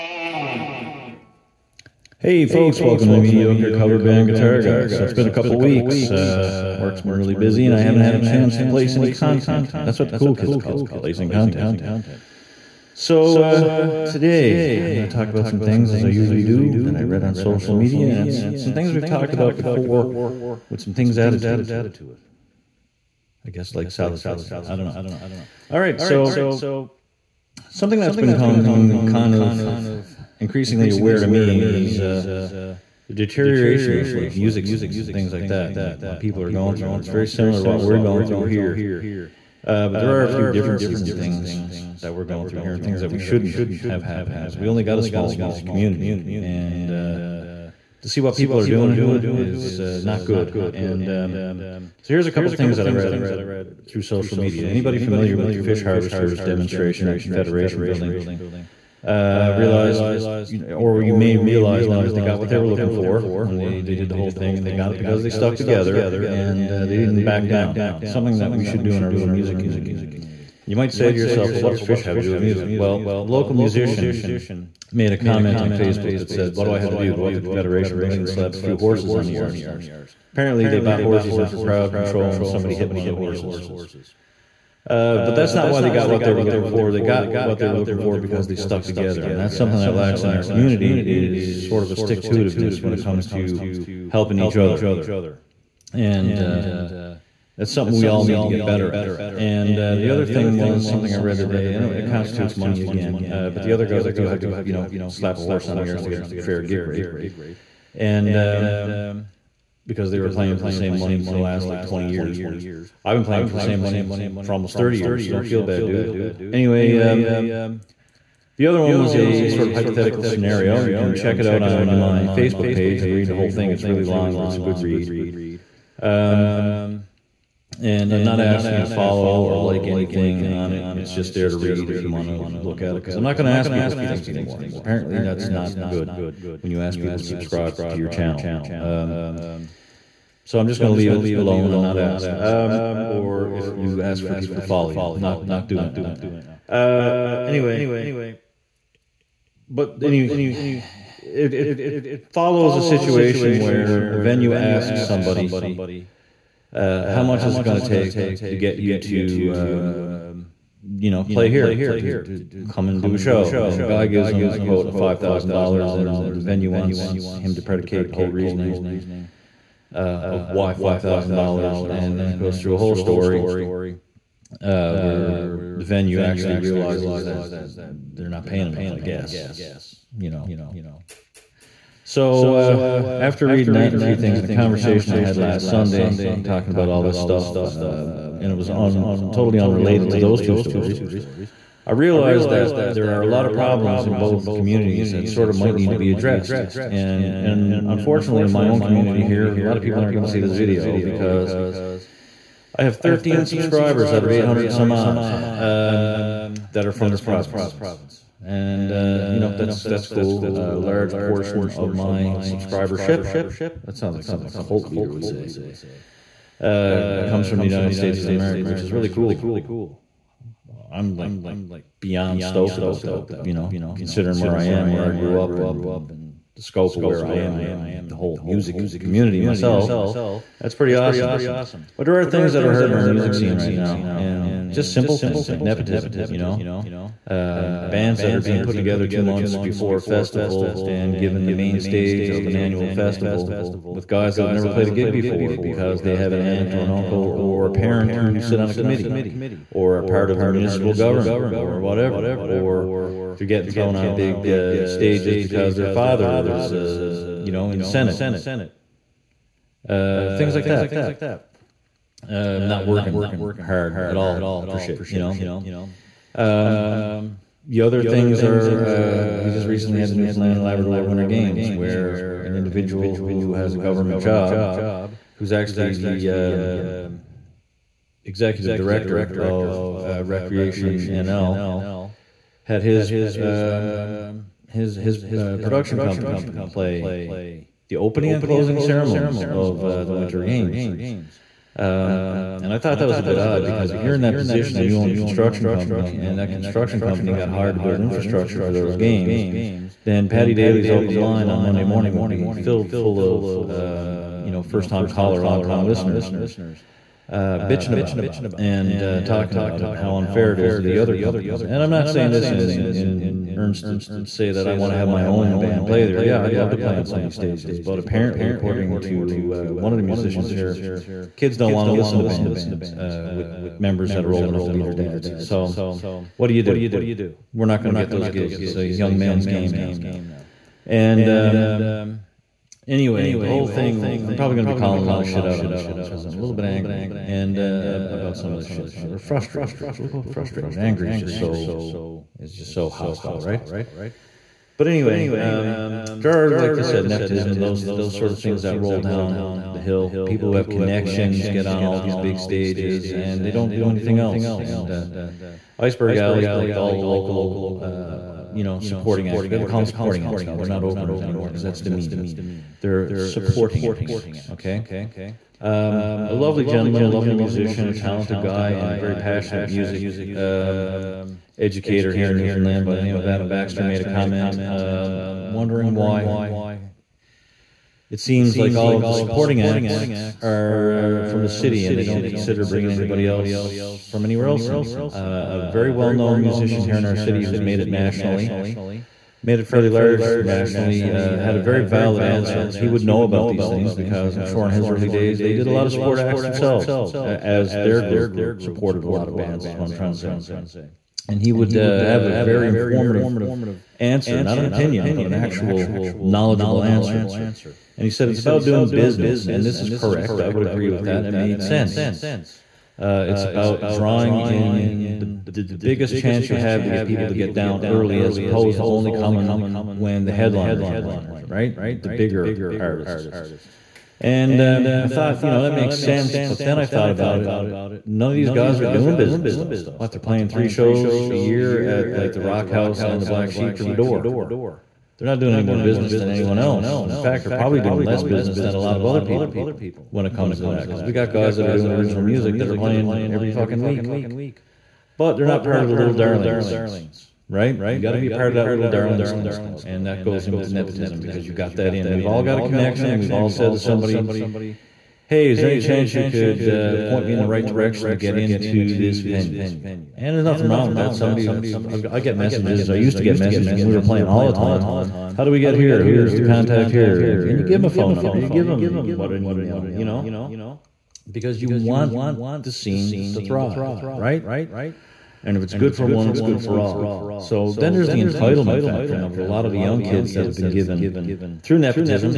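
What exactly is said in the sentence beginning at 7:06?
But then I thought about it.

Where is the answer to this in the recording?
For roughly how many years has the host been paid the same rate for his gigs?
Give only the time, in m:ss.
1:54.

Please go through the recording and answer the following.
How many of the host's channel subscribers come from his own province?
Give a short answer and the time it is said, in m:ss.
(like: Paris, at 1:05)
13, at 3:22.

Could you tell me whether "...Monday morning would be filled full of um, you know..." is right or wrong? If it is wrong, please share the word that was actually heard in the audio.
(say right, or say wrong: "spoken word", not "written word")
right.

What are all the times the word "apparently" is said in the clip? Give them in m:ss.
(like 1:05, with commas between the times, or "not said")
1:20, 2:14, 5:17.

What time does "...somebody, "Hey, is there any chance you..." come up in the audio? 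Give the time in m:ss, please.
7:33.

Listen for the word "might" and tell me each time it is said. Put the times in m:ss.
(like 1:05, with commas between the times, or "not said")
1:10, 3:15.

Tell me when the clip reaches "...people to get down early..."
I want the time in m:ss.
6:57.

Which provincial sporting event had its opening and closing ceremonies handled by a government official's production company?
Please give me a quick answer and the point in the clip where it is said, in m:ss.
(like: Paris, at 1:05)
Newfoundland and Labrador Winter Games, at 4:30.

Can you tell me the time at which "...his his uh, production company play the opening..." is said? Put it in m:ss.
4:44.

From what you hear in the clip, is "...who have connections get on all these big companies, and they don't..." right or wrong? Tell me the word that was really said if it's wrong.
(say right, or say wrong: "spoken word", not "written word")
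wrong: "stages", not "companies".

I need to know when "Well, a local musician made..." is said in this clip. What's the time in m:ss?
1:12.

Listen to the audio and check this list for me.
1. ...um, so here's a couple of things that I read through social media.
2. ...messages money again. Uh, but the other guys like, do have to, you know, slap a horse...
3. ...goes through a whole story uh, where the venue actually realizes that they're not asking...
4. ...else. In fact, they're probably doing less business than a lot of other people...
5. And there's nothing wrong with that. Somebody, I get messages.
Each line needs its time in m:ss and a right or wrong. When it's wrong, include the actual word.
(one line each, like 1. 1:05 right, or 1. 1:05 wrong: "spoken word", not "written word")
1. 0:51 right
2. 1:42 wrong: "constitutes", not "messages"
3. 2:52 wrong: "paying", not "asking"
4. 7:16 right
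5. 7:40 right.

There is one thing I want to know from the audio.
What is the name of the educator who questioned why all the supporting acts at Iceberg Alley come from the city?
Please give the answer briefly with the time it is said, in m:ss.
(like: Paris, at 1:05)
Adam Baxter, at 6:13.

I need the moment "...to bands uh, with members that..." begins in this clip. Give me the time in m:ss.
5:22.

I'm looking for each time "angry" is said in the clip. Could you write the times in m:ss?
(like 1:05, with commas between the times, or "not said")
5:36, 5:40.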